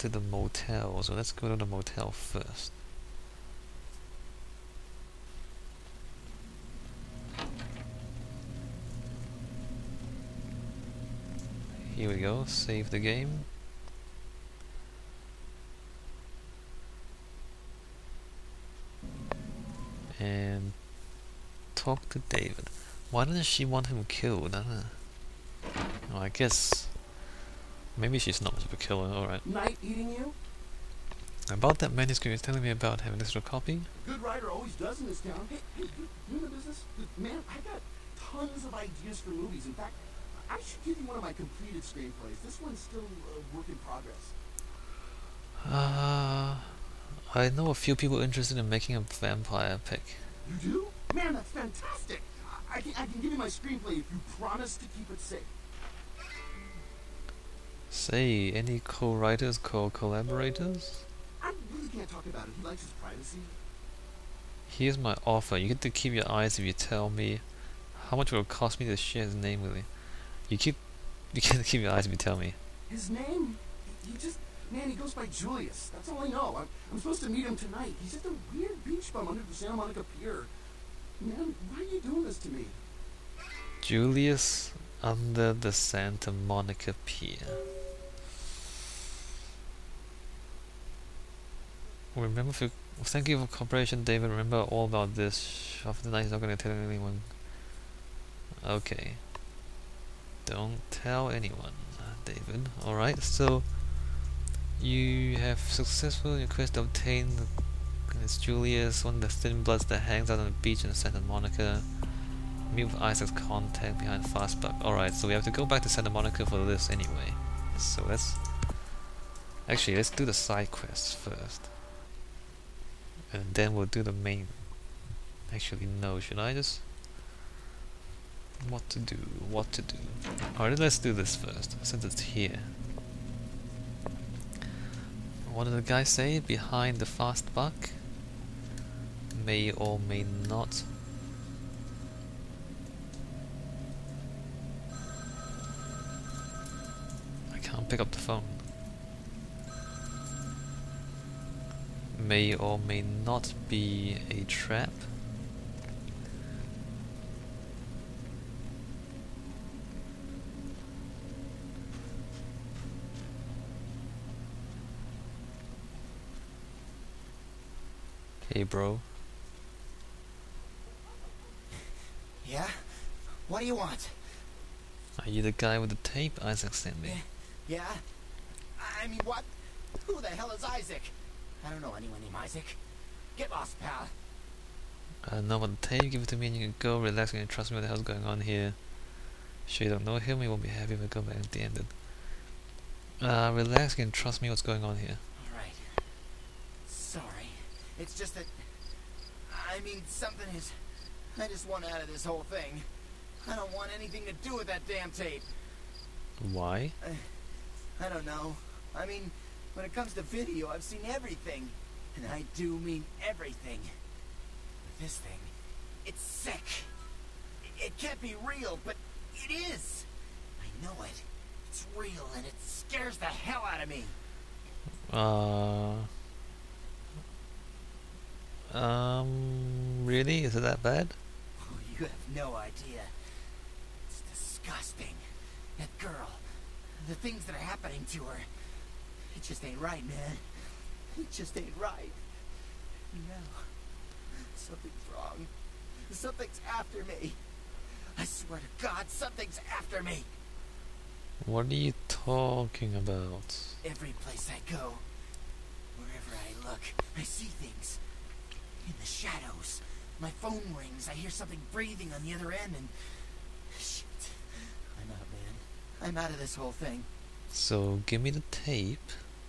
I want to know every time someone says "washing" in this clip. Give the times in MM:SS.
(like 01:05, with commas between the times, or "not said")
not said.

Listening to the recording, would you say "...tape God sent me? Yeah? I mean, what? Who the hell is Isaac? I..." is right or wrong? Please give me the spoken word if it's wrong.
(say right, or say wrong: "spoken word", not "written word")
wrong: "Isaac", not "God".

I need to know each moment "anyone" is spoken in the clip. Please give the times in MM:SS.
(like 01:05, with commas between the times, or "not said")
01:36, 01:41, 03:01.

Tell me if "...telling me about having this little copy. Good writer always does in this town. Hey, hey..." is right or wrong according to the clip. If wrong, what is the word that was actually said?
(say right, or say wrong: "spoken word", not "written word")
right.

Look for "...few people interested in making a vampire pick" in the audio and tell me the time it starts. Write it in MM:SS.
00:47.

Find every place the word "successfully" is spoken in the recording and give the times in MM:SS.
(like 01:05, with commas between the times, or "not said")
01:45.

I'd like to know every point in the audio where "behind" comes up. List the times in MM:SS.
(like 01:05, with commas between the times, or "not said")
01:53, 02:16.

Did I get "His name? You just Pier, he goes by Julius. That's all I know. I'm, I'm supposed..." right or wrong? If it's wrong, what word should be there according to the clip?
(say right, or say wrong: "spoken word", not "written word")
wrong: "Man", not "Pier".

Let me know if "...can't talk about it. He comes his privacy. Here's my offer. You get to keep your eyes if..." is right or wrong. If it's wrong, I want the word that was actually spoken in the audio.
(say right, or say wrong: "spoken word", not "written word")
wrong: "likes", not "comes".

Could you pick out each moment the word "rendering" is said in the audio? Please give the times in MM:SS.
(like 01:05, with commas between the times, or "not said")
not said.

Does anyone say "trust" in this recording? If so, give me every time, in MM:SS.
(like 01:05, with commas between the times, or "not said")
03:07, 03:14.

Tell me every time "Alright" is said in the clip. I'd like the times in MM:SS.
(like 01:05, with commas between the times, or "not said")
01:42, 01:54, 02:10.